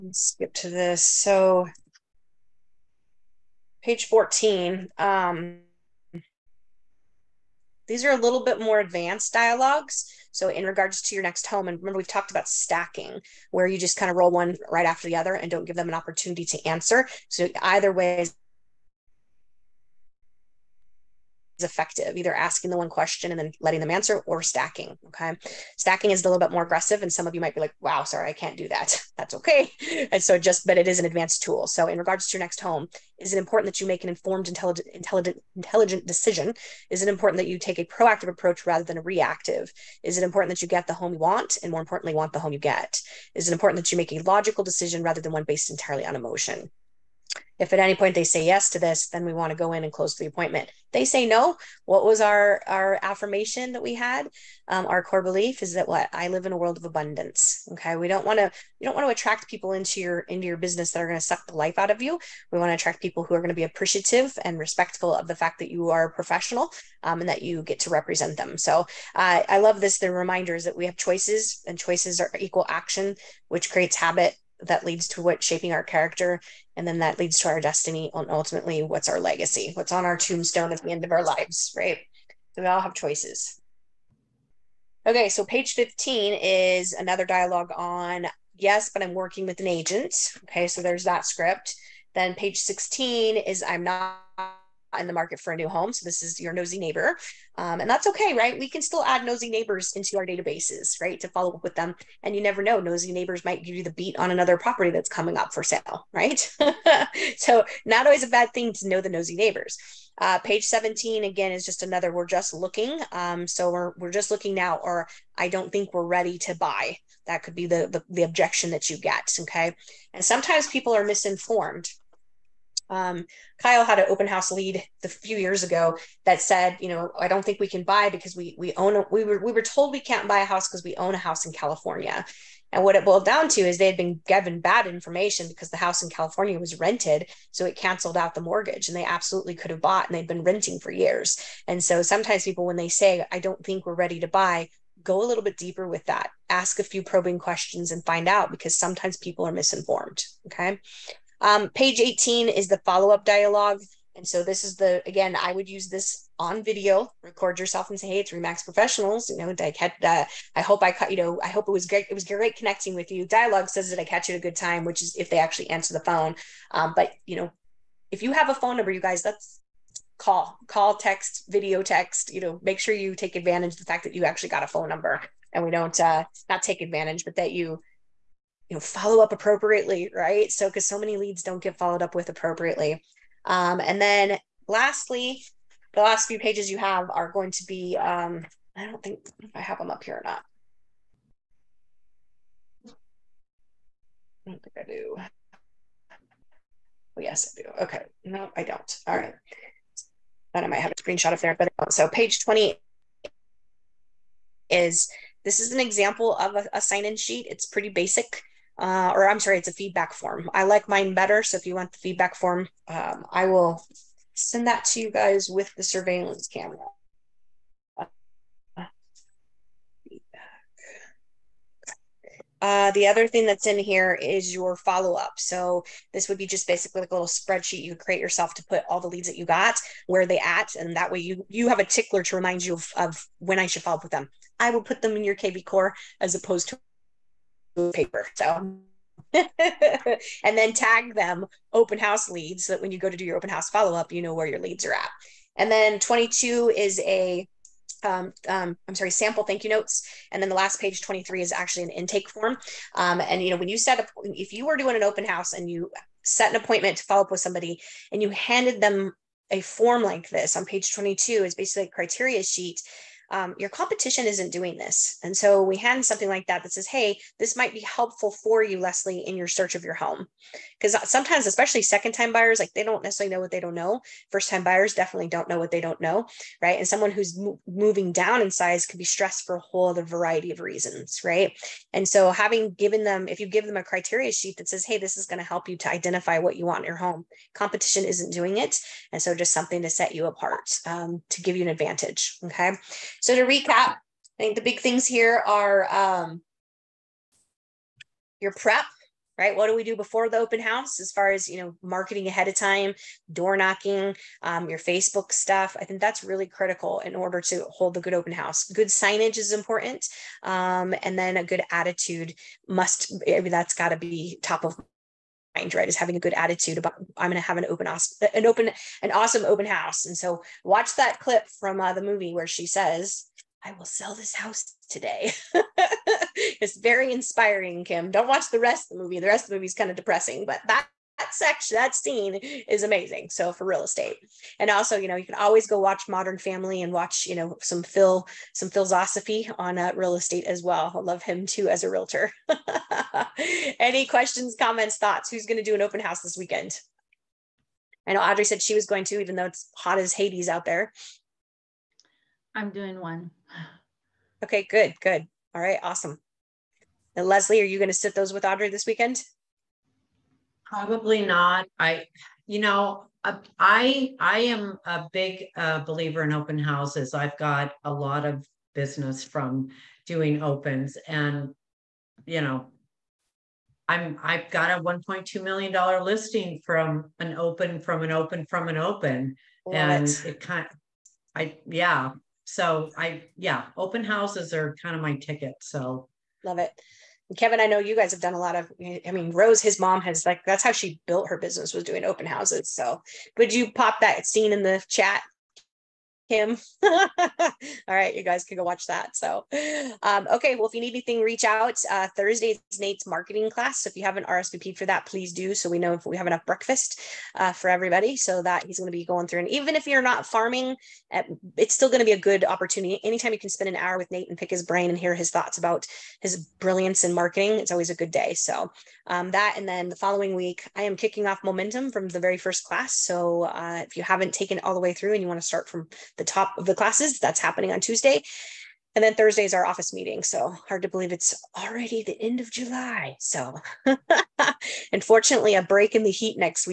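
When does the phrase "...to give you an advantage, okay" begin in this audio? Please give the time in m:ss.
4:51.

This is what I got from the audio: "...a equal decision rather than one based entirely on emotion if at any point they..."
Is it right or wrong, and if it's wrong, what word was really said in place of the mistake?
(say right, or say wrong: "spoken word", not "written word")
wrong: "logical", not "equal".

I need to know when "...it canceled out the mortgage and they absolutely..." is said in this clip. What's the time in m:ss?
2:17.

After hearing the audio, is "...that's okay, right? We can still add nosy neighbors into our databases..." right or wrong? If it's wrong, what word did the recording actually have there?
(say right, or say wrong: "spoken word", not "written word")
right.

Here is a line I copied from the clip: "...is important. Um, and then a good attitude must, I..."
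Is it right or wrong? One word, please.
right.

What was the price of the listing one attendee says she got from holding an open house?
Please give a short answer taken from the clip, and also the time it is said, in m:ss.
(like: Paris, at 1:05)
$1.2 million, at 6:14.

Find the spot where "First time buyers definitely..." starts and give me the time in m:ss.
4:34.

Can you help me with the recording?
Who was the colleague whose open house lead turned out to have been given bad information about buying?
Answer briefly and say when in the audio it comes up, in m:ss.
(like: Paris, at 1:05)
Kyle, at 2:03.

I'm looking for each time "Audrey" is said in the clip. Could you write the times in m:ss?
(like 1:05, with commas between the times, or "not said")
5:48, 5:58.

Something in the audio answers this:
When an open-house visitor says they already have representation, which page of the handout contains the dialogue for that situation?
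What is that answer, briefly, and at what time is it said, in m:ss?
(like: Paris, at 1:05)
15, at 1:25.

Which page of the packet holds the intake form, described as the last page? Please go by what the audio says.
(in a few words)
23.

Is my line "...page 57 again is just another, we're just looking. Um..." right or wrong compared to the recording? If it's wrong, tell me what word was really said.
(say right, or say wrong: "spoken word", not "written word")
wrong: "17", not "57".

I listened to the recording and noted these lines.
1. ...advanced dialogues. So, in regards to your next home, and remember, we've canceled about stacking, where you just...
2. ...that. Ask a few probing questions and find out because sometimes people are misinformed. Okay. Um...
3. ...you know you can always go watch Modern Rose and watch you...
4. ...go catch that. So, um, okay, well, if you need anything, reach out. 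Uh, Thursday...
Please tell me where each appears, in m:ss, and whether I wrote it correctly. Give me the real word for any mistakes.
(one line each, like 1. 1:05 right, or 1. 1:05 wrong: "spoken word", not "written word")
1. 0:08 wrong: "talked", not "canceled"
2. 2:26 right
3. 5:34 wrong: "Family", not "Rose"
4. 6:38 wrong: "watch", not "catch".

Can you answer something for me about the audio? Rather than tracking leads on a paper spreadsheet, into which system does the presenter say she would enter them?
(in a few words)
KV Core.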